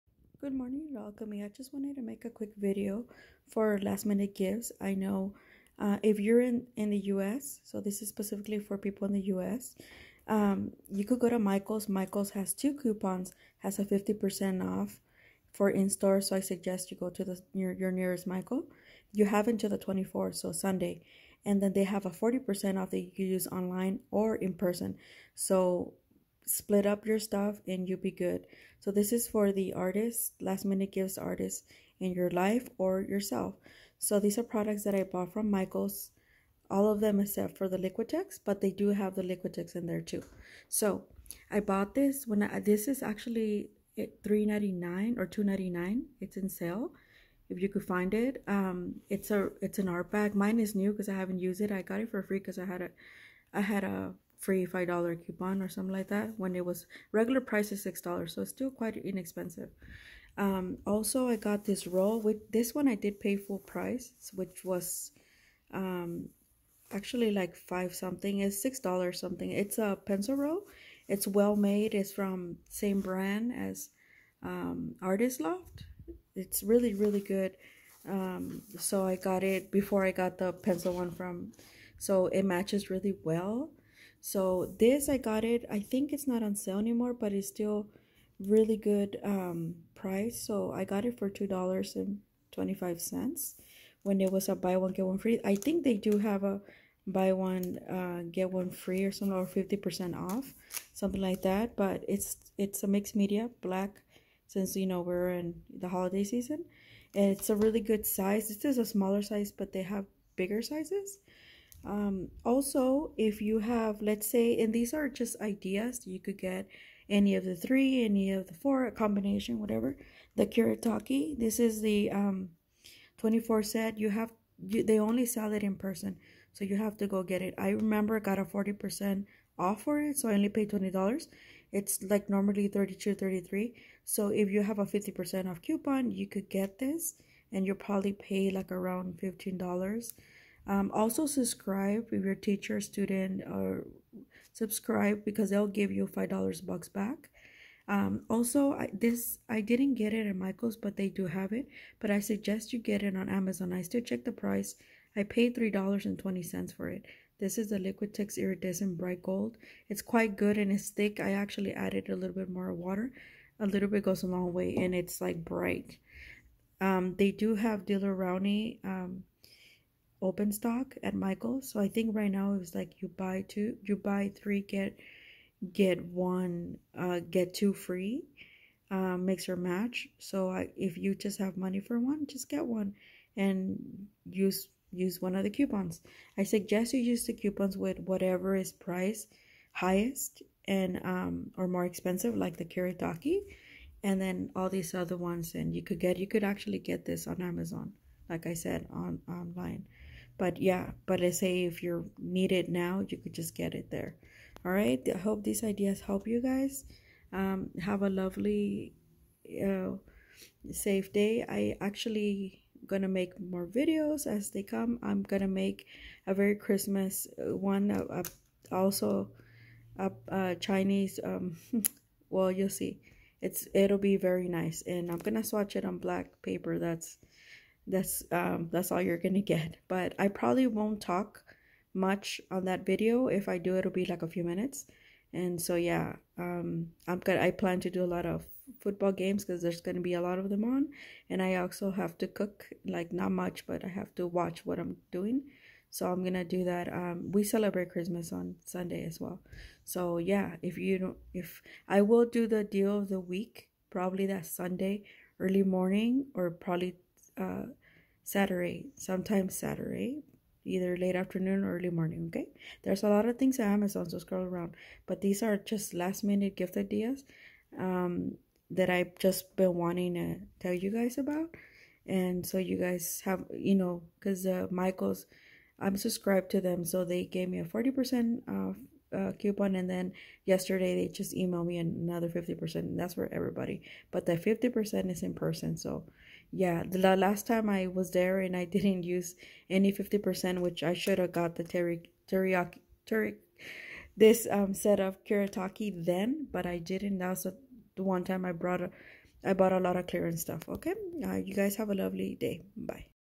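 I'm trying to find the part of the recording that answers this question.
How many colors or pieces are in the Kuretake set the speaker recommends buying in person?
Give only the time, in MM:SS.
02:03.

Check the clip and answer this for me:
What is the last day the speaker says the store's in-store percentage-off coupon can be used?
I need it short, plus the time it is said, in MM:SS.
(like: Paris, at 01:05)
the 24th, at 00:19.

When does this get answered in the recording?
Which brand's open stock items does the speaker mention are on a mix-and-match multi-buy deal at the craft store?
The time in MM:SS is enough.
02:47.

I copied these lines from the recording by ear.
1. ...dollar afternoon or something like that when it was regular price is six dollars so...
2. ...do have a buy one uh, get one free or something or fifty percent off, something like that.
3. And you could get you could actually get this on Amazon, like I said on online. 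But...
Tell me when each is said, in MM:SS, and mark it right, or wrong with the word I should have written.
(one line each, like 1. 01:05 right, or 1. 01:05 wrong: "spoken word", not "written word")
1. 00:54 wrong: "coupon", not "afternoon"
2. 01:35 right
3. 03:15 right.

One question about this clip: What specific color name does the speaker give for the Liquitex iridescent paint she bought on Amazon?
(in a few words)
Bright Gold.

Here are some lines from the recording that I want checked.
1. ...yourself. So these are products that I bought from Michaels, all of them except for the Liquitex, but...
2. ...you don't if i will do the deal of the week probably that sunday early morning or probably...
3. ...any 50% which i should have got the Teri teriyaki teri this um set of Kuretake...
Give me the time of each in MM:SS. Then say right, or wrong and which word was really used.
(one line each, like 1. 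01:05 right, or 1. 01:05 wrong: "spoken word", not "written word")
1. 00:33 right
2. 04:10 right
3. 04:49 right.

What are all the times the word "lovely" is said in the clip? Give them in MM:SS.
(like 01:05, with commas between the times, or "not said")
03:28, 05:01.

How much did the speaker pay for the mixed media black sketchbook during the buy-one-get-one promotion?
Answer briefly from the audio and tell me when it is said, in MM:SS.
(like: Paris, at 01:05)
$2.25, at 01:31.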